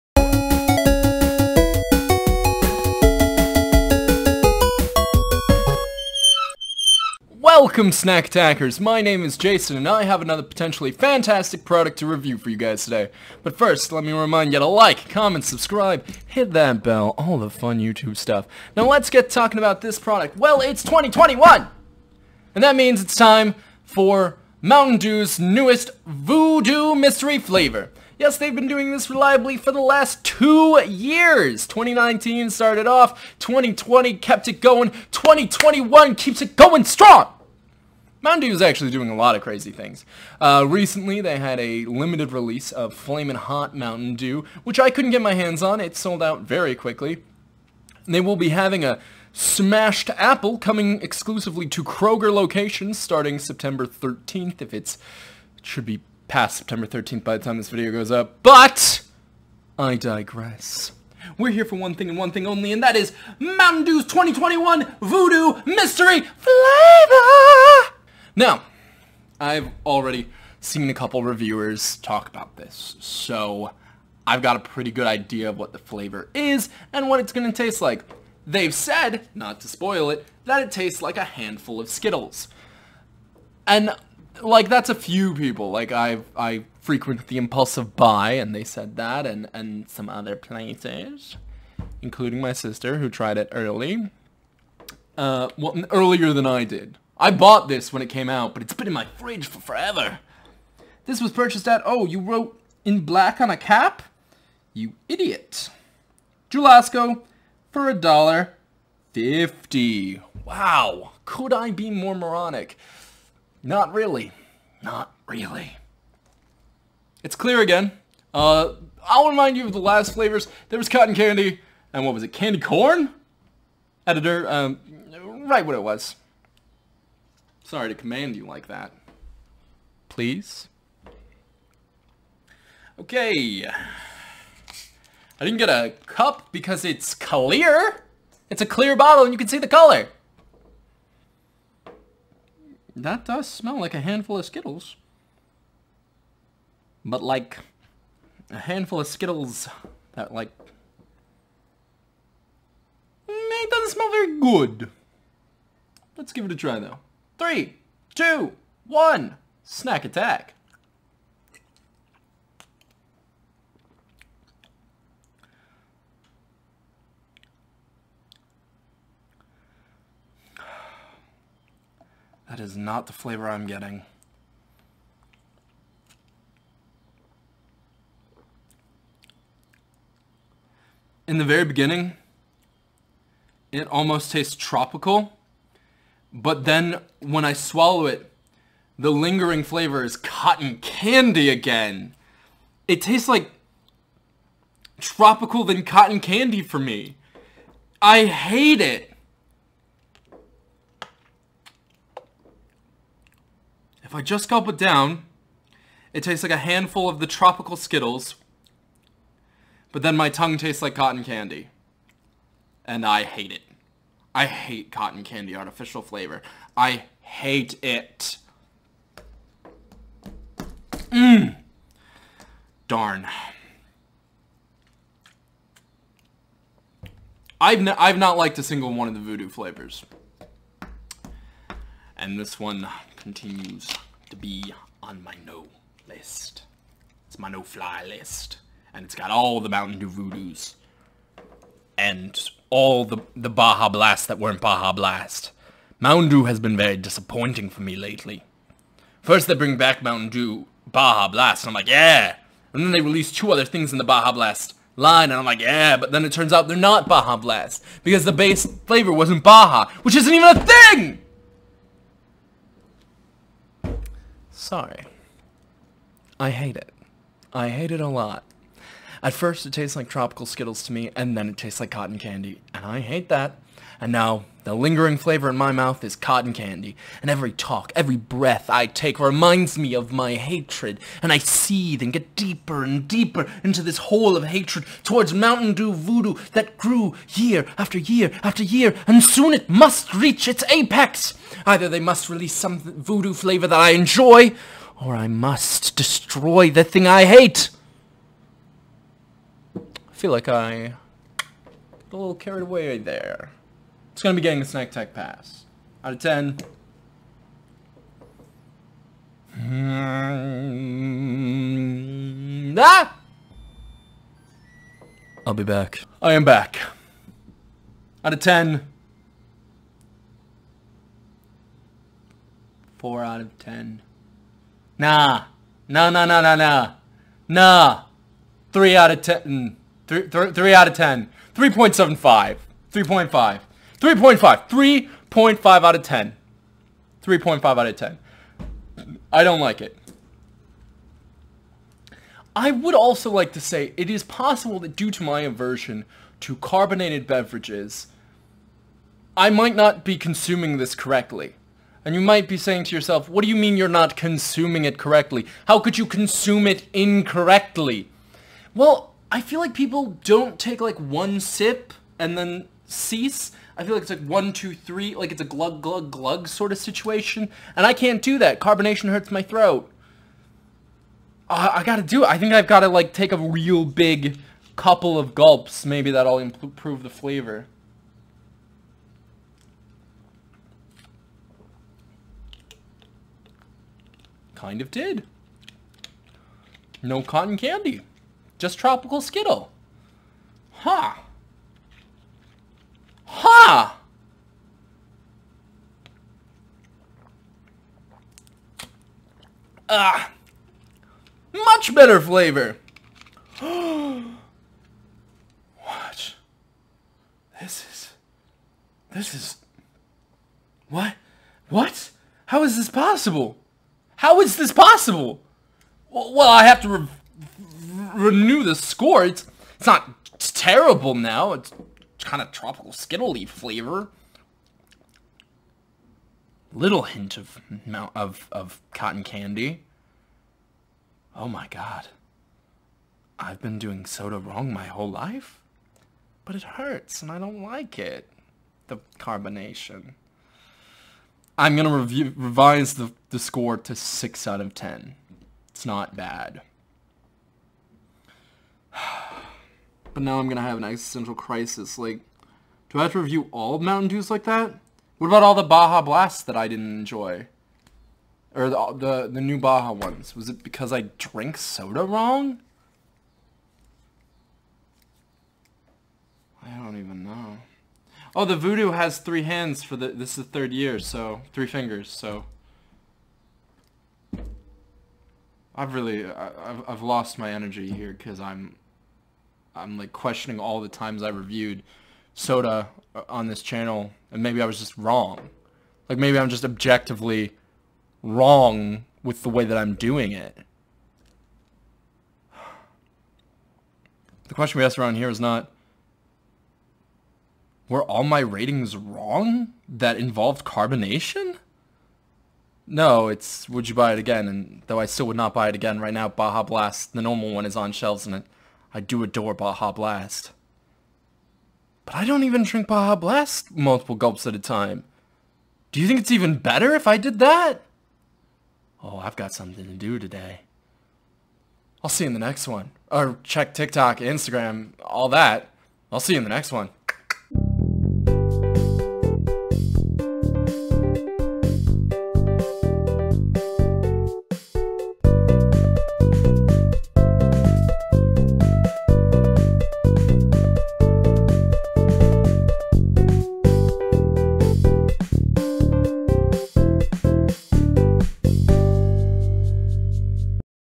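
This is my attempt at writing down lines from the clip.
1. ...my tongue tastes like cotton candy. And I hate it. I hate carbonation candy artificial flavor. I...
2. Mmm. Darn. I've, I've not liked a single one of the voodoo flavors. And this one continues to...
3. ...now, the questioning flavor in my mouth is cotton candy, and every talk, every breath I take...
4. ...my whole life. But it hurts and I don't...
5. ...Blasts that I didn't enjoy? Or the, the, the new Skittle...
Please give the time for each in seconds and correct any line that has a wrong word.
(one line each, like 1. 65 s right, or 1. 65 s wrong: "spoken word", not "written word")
1. 210 s wrong: "cotton", not "carbonation"
2. 221 s right
3. 274 s wrong: "lingering", not "questioning"
4. 434 s right
5. 456 s wrong: "Baja", not "Skittle".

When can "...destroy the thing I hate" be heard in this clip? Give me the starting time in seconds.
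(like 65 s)
295 s.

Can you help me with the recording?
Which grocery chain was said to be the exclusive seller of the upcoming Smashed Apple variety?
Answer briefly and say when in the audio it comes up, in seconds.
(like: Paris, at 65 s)
Kroger, at 51 s.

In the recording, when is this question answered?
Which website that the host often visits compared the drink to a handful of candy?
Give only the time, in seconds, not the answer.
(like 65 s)
87 s.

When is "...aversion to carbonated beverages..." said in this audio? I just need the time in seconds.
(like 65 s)
345 s.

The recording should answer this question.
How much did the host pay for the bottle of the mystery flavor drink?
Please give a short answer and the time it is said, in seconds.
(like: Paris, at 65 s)
$1.50, at 107 s.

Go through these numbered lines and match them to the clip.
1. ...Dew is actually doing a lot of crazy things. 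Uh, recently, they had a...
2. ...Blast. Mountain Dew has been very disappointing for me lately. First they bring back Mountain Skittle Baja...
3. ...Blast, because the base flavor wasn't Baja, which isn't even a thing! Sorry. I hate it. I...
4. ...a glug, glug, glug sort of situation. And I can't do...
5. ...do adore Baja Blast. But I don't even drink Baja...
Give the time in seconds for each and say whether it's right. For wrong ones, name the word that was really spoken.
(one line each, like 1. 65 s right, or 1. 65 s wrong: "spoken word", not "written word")
1. 38 s right
2. 244 s wrong: "Dew", not "Skittle"
3. 257 s right
4. 365 s right
5. 508 s right.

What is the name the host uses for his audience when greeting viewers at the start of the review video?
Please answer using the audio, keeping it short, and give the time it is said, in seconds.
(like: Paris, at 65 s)
Snack Attackerz, at 7 s.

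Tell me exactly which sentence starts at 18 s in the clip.
Now let's get talking about this product.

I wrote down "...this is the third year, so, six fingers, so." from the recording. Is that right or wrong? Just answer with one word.
wrong.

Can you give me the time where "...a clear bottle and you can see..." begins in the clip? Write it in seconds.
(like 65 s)
138 s.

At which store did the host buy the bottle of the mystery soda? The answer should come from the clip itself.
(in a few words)
Jewel-Osco.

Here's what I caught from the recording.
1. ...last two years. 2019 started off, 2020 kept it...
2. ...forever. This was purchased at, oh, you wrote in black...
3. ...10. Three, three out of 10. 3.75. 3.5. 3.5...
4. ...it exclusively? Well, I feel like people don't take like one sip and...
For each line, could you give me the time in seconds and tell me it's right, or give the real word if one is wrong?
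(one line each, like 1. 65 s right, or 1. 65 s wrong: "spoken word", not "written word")
1. 29 s right
2. 99 s right
3. 329 s right
4. 356 s wrong: "incorrectly", not "exclusively".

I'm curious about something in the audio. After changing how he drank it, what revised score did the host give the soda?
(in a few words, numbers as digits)
6 out of 10.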